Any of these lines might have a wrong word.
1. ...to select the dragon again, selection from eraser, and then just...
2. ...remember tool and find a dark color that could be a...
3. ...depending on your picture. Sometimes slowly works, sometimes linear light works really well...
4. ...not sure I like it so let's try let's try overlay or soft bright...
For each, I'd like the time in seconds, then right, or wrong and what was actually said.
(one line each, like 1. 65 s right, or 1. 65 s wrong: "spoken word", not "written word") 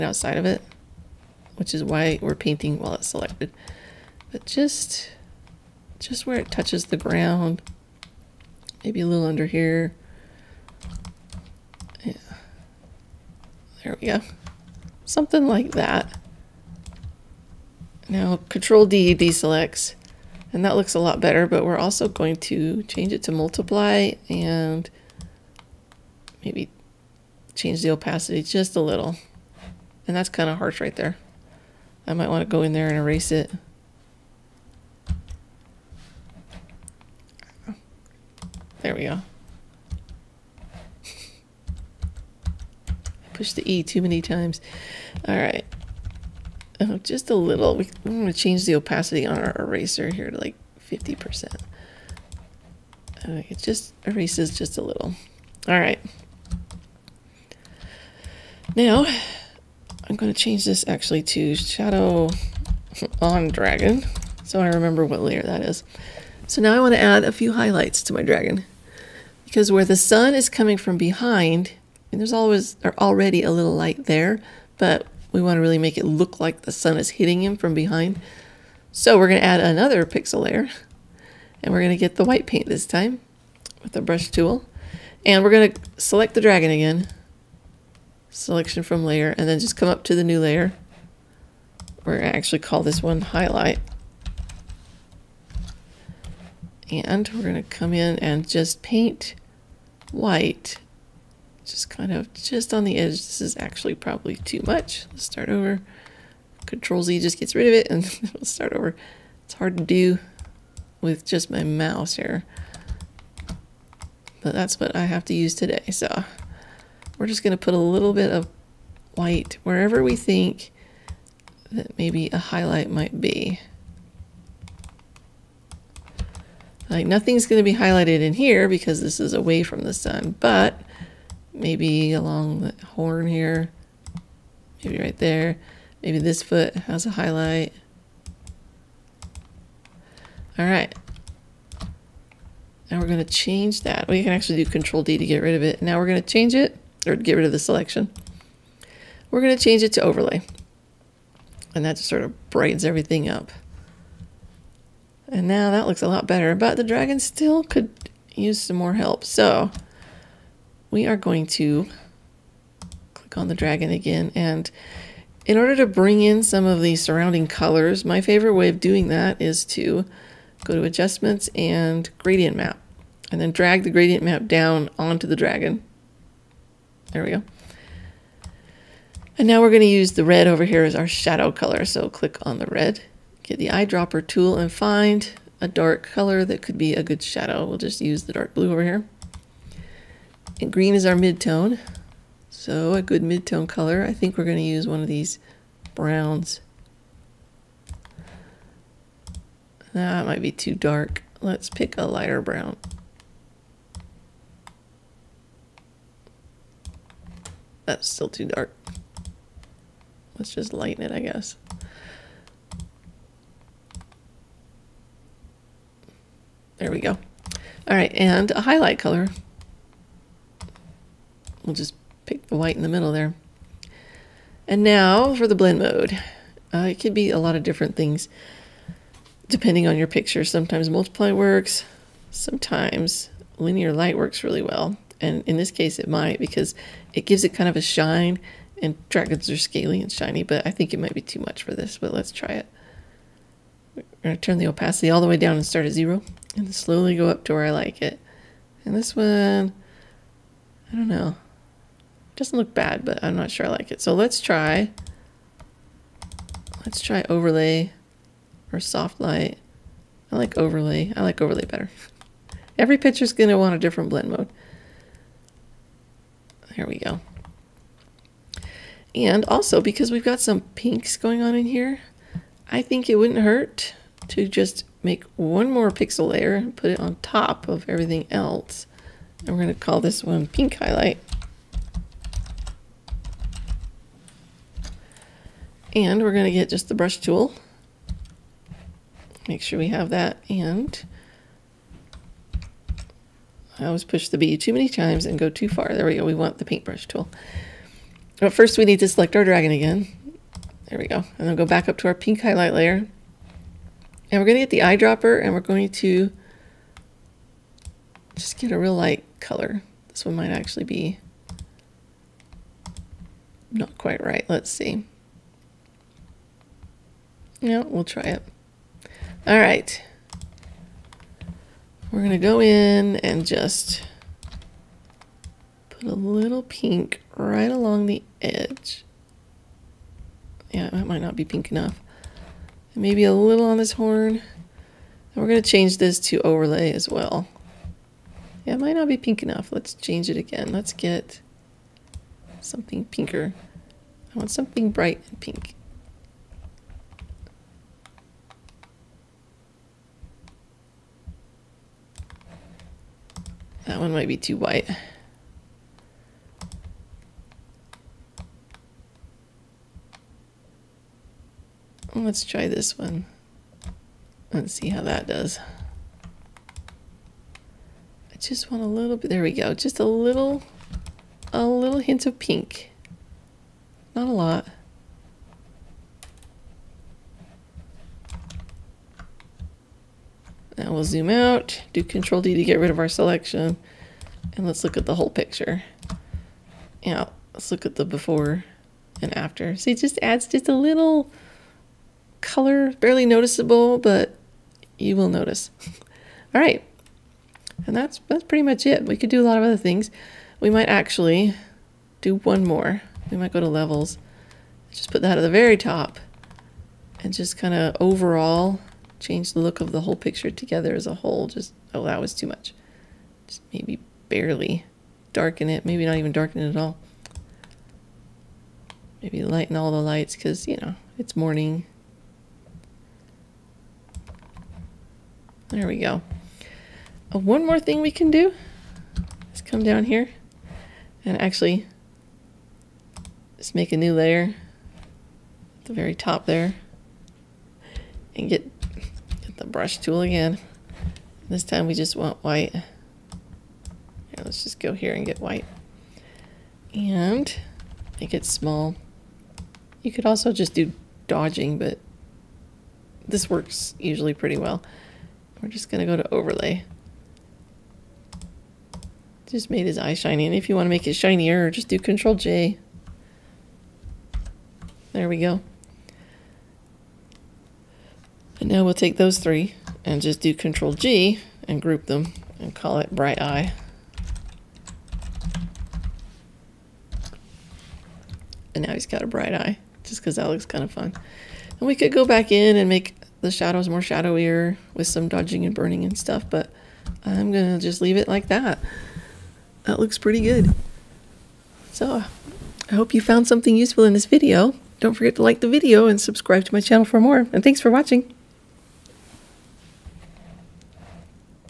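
1. 85 s wrong: "layer", not "eraser"
2. 183 s wrong: "eyedropper", not "remember"
3. 229 s wrong: "multiply", not "slowly"
4. 253 s wrong: "light", not "bright".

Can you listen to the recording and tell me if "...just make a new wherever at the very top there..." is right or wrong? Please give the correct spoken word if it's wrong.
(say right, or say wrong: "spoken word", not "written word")
wrong: "layer", not "wherever".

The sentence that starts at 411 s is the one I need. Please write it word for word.
Just, oh, that was too much.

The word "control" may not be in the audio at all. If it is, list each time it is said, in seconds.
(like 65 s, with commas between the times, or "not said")
18 s, 106 s, 144 s, 382 s, 461 s, 470 s.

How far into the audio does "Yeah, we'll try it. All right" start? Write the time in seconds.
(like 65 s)
317 s.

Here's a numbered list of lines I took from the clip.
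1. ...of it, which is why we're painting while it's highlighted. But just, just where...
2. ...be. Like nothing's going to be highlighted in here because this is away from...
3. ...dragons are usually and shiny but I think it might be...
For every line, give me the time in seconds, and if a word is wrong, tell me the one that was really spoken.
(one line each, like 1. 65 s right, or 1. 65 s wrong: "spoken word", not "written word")
1. 0 s wrong: "selected", not "highlighted"
2. 123 s right
3. 239 s wrong: "scaly", not "usually".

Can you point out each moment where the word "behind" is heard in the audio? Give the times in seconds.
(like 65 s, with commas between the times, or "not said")
70 s, 77 s.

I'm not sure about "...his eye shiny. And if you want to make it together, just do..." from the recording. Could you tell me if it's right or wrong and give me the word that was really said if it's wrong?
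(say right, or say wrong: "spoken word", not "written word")
wrong: "shinier", not "together".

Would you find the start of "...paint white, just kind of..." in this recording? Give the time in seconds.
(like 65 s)
98 s.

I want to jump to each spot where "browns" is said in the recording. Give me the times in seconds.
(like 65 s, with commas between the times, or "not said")
195 s, 202 s.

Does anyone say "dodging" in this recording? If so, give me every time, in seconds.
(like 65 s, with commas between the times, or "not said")
451 s, 485 s.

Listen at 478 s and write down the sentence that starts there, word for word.
And now he's got a bright eye just because that looks kind of fun.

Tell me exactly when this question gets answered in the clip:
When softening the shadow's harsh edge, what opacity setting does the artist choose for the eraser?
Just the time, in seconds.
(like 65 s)
50 s.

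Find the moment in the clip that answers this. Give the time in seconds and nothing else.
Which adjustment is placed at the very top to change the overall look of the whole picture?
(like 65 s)
403 s.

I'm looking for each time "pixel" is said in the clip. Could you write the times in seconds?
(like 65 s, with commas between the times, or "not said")
80 s, 275 s.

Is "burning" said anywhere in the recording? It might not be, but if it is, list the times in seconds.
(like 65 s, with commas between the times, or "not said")
485 s.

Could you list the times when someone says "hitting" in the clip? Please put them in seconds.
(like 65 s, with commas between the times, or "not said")
77 s.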